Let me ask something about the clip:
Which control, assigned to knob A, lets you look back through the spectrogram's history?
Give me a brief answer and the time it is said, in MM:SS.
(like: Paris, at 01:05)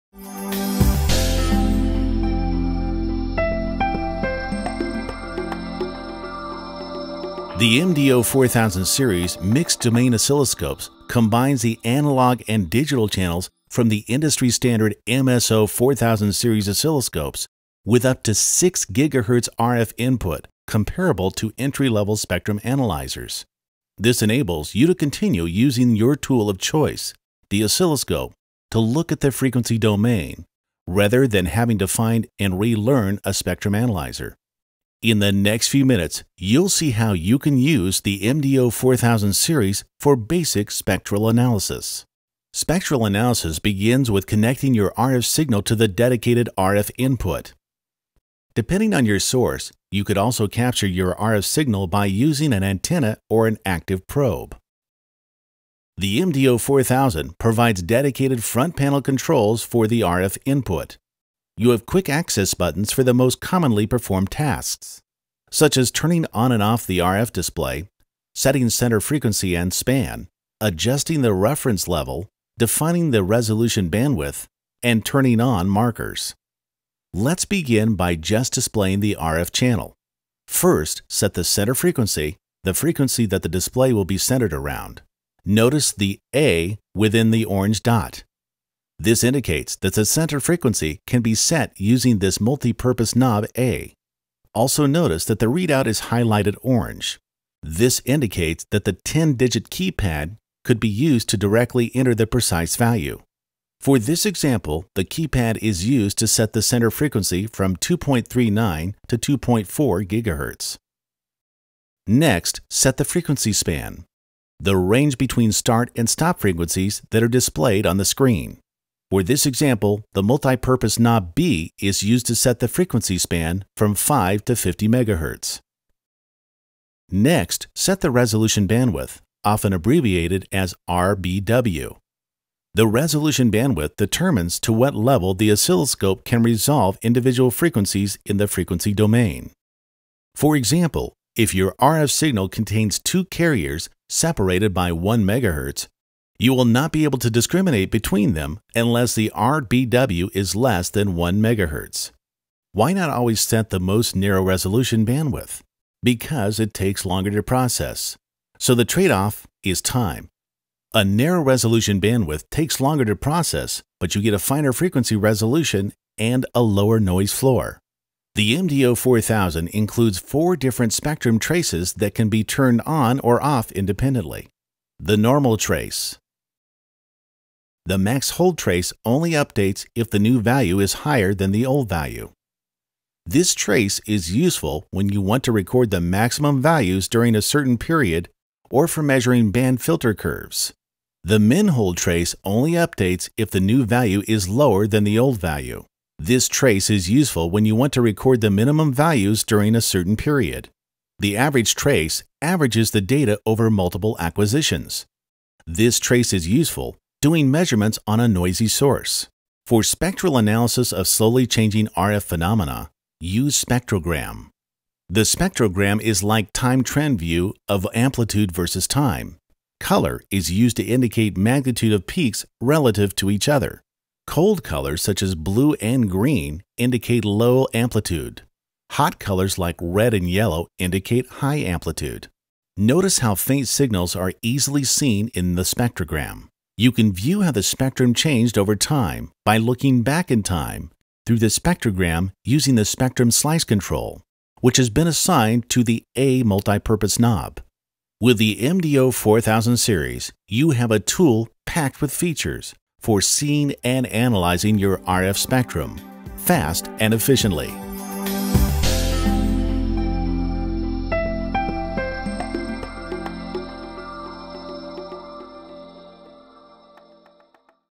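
spectrum slice, at 04:02.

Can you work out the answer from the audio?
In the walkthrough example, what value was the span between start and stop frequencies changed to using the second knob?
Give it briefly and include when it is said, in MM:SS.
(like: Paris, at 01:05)
50 MHz, at 02:04.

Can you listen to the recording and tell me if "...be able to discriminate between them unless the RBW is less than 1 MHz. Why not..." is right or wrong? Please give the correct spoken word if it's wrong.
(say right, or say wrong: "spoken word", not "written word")
right.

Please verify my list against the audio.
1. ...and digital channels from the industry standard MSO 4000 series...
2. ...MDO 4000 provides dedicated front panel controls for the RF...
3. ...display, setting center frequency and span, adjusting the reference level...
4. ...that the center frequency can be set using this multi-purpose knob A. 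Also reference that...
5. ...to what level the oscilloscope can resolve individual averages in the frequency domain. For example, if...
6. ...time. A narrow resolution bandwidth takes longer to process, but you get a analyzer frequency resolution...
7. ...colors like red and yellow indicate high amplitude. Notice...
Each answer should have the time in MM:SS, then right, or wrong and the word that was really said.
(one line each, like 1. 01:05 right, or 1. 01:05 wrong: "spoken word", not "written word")
1. 00:12 right
2. 00:56 right
3. 01:07 right
4. 01:29 wrong: "notice", not "reference"
5. 02:14 wrong: "frequencies", not "averages"
6. 02:39 wrong: "finer", not "analyzer"
7. 03:49 right.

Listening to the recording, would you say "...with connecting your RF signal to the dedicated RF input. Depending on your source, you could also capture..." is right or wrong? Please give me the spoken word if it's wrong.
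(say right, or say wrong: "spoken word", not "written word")
right.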